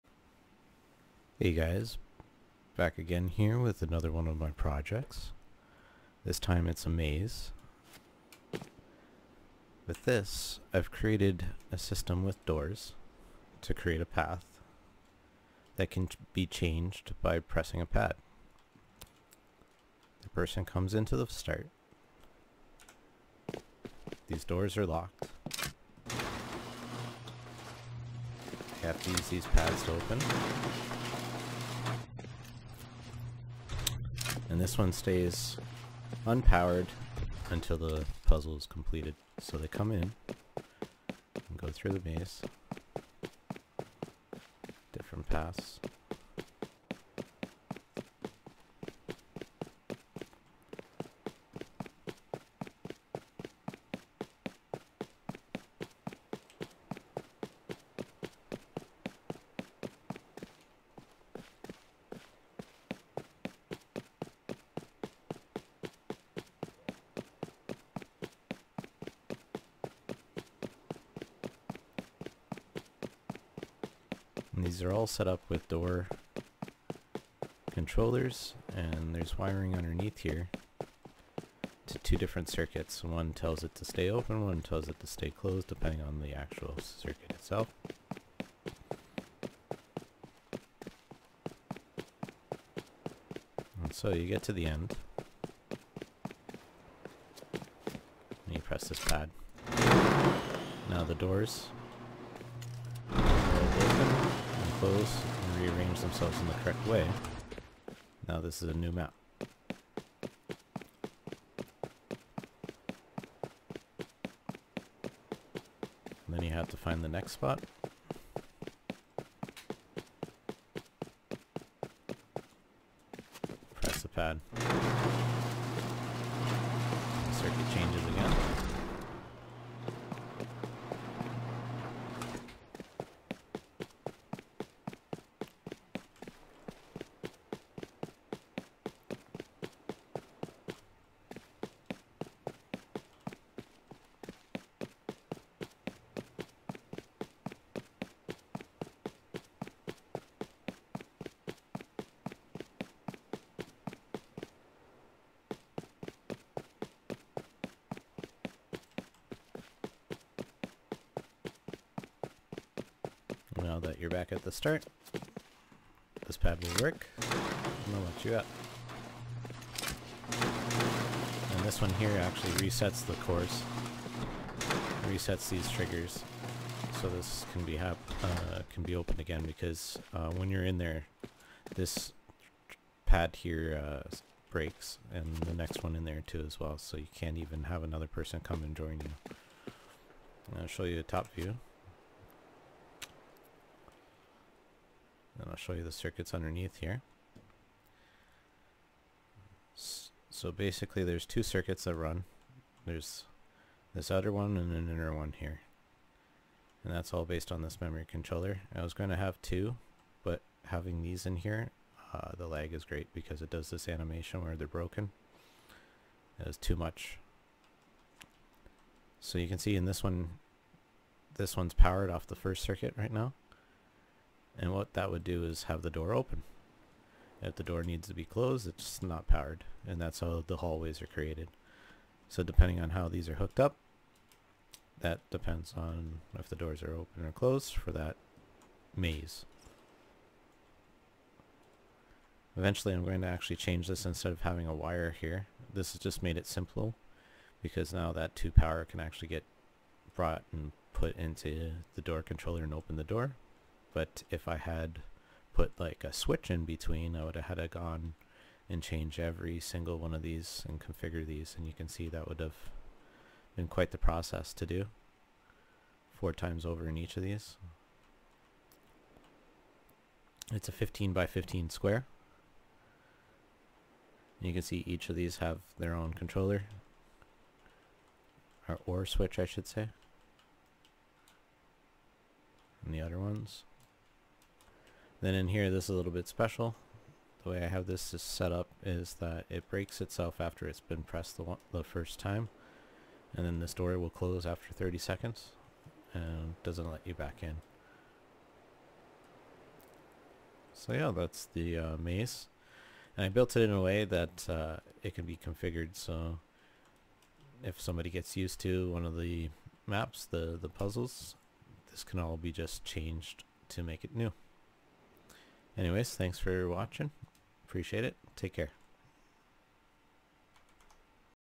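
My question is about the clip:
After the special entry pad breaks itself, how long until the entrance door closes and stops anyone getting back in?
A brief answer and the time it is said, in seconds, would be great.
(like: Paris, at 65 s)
30 seconds, at 294 s.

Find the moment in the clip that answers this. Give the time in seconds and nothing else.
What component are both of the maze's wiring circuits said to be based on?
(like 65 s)
207 s.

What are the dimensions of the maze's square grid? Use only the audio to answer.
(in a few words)
15 by 15.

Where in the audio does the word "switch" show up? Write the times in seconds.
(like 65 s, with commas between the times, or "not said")
256 s, 279 s.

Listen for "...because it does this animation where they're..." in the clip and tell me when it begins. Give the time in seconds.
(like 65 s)
213 s.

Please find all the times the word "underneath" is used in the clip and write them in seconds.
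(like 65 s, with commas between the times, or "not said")
79 s, 196 s.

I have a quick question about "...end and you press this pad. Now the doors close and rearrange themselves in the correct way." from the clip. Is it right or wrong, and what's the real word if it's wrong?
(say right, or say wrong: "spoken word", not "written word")
right.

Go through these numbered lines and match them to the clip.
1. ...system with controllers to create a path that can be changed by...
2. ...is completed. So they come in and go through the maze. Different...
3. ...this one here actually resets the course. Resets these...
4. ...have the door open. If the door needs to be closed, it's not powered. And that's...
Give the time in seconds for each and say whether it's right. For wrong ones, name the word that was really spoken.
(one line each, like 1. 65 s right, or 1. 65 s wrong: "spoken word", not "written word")
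1. 11 s wrong: "doors", not "controllers"
2. 38 s right
3. 171 s right
4. 225 s right.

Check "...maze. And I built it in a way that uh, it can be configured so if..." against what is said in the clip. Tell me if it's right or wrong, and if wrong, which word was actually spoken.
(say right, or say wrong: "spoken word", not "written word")
right.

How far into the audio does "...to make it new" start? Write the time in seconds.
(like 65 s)
313 s.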